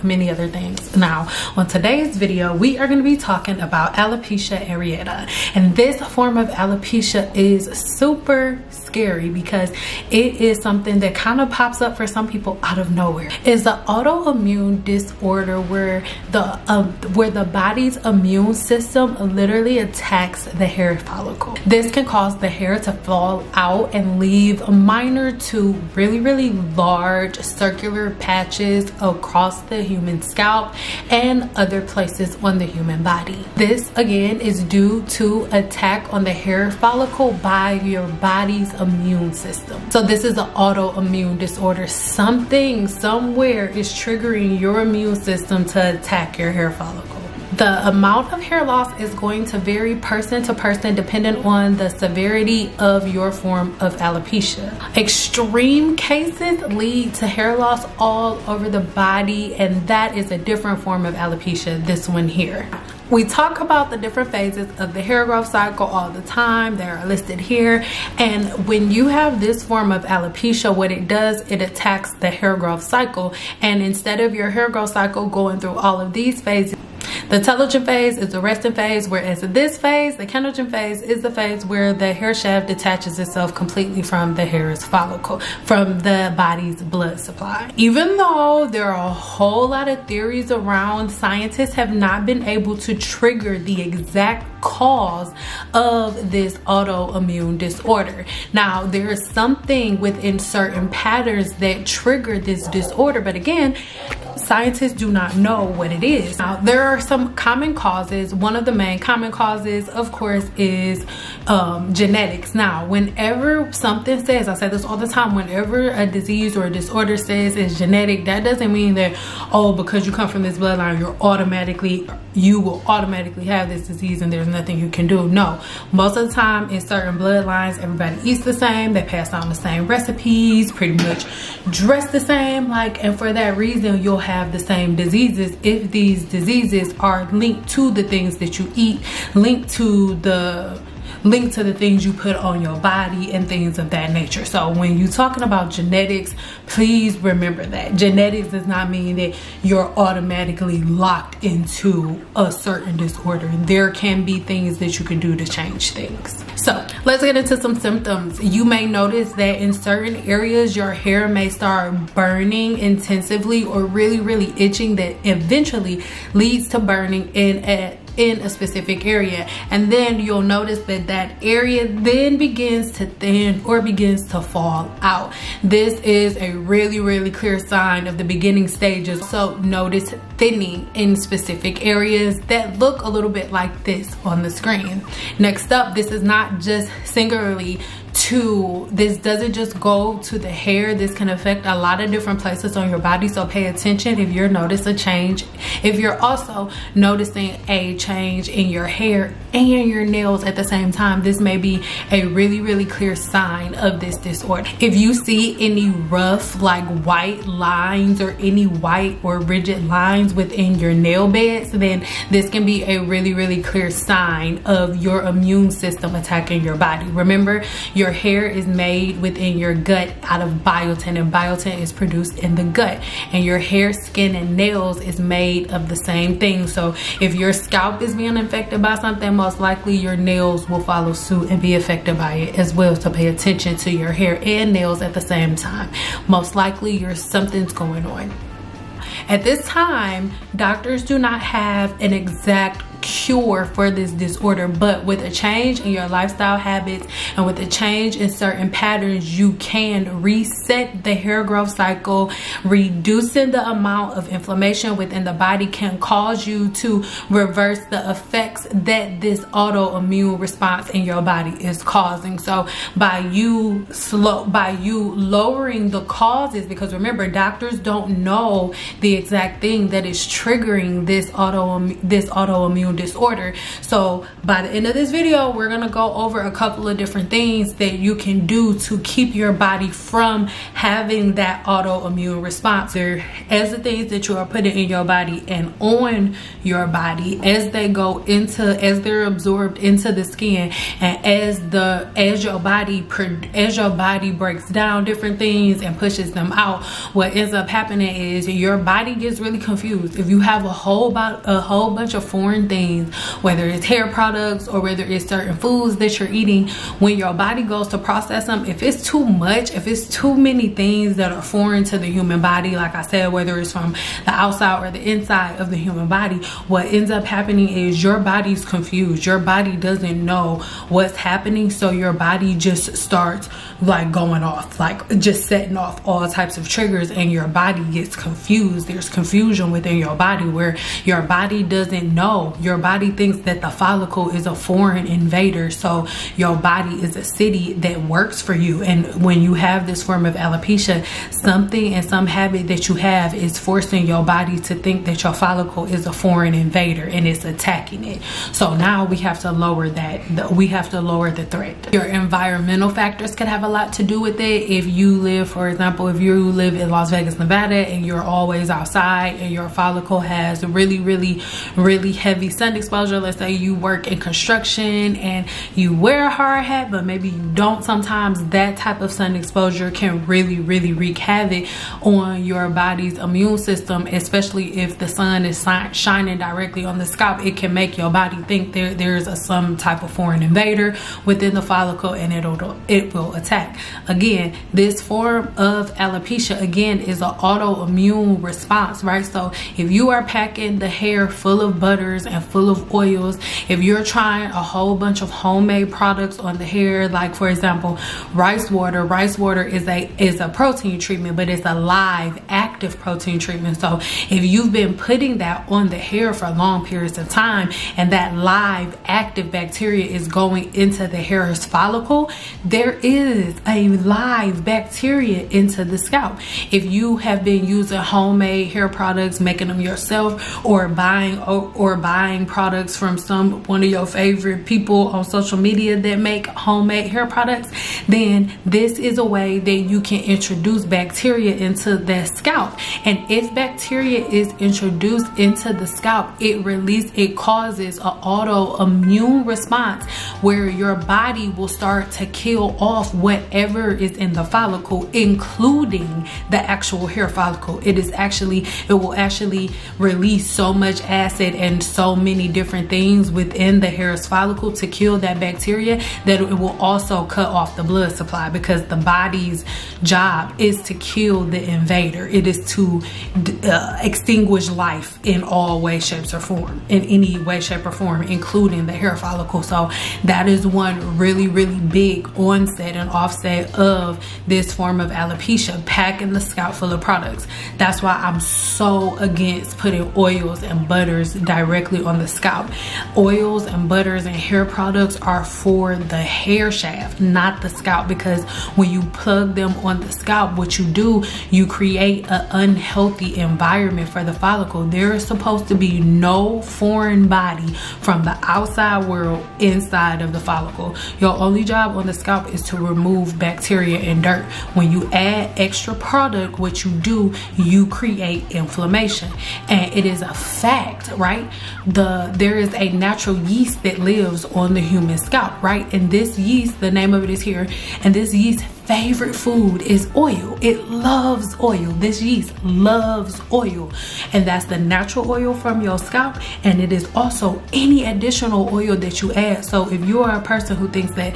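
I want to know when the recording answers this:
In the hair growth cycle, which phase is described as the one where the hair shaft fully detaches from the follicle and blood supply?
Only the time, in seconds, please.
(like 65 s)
80 s.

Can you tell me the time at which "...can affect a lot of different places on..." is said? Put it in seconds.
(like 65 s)
191 s.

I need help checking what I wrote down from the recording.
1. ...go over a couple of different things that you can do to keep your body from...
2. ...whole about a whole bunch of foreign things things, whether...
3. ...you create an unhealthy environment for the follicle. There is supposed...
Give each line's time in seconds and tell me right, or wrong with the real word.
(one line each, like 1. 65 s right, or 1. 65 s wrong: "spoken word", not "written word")
1. 275 s right
2. 300 s right
3. 491 s right.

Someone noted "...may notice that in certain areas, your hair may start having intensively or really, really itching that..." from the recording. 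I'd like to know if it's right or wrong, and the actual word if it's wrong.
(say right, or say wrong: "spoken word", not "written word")
wrong: "burning", not "having".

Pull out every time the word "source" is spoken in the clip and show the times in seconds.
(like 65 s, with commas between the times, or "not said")
not said.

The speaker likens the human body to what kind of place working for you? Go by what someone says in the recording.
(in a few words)
a city.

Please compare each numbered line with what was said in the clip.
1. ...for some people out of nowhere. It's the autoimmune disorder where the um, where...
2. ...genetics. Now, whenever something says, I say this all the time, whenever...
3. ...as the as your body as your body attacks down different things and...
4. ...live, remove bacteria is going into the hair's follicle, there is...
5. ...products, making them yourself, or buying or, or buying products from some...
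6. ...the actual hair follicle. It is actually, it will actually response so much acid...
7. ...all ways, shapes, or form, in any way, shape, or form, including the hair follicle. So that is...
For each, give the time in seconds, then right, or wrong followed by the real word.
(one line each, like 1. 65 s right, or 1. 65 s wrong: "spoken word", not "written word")
1. 11 s right
2. 111 s right
3. 291 s wrong: "breaks", not "attacks"
4. 408 s wrong: "active", not "remove"
5. 418 s right
6. 446 s wrong: "release", not "response"
7. 465 s right.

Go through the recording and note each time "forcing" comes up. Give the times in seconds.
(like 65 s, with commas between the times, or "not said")
343 s.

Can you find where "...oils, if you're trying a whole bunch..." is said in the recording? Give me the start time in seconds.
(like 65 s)
392 s.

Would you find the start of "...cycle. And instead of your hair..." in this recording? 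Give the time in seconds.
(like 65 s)
72 s.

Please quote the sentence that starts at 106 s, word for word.
Now, there are some common causes.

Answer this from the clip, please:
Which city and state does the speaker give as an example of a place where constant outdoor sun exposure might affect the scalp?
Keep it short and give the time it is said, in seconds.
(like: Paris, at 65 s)
Las Vegas, Nevada, at 356 s.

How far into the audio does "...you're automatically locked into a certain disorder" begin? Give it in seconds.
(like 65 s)
149 s.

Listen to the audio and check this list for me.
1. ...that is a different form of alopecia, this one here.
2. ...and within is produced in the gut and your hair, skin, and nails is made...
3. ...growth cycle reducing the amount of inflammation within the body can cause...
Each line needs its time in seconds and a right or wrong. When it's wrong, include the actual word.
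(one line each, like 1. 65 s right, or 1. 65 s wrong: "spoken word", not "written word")
1. 59 s right
2. 221 s wrong: "biotin", not "within"
3. 251 s right.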